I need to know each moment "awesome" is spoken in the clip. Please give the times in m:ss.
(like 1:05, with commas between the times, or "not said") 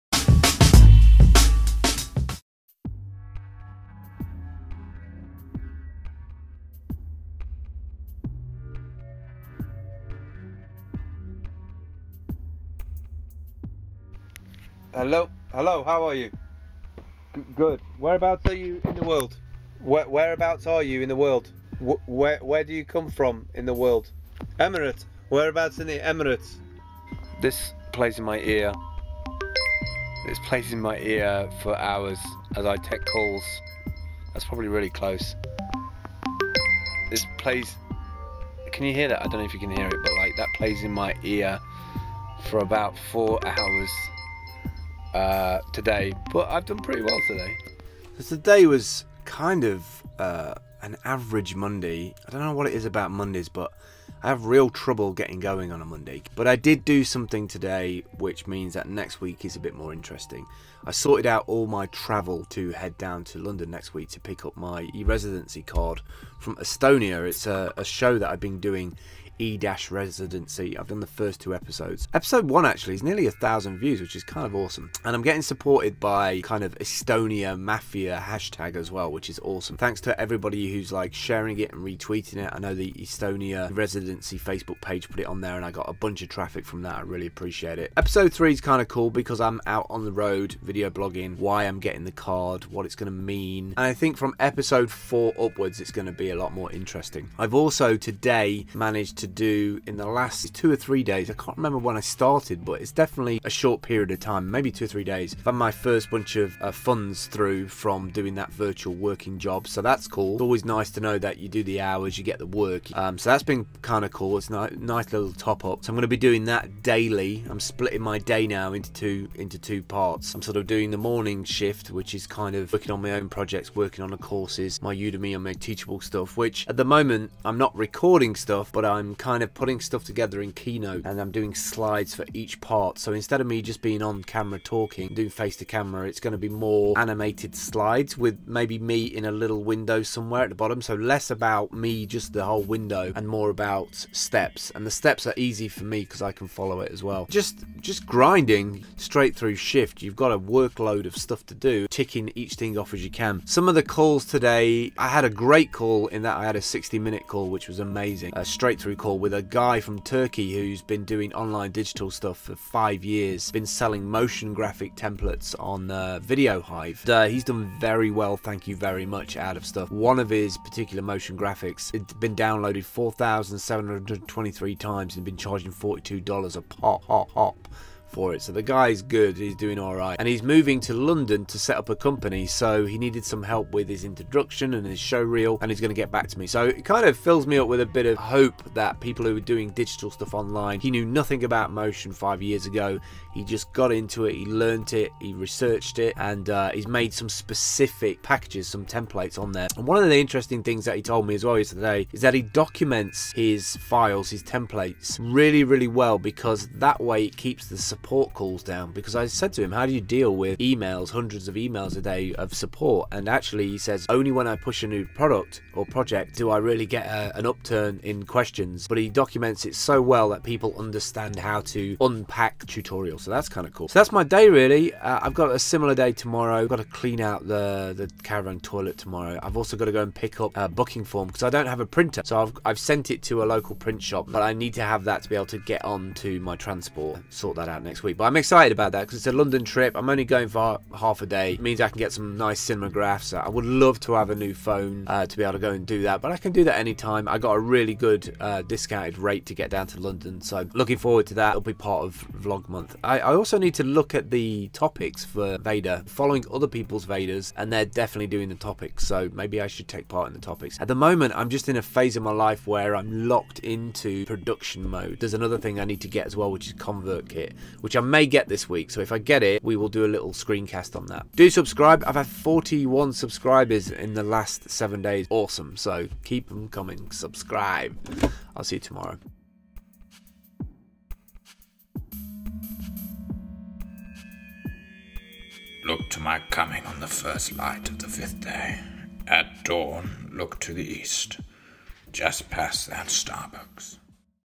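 1:14, 1:19, 4:35.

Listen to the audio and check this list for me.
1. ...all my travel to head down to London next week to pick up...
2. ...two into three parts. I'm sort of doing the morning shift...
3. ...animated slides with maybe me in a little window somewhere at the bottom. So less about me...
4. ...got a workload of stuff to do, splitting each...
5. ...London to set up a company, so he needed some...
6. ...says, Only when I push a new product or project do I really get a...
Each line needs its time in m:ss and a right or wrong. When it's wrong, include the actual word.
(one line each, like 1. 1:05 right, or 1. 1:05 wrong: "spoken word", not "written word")
1. 1:01 right
2. 1:58 wrong: "two", not "three"
3. 2:16 right
4. 2:30 wrong: "ticking", not "splitting"
5. 3:00 right
6. 3:33 right.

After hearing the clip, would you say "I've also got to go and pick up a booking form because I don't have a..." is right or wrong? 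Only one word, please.
right.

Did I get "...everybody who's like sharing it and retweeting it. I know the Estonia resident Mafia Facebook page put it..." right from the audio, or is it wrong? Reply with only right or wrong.
wrong.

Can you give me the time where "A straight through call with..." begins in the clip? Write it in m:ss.
2:38.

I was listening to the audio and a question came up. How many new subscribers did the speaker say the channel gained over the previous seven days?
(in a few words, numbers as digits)
41.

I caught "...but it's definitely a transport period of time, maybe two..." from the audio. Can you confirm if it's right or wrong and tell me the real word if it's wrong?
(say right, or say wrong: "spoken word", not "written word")
wrong: "short", not "transport".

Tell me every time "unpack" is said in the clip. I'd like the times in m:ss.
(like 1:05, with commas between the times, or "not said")
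3:42.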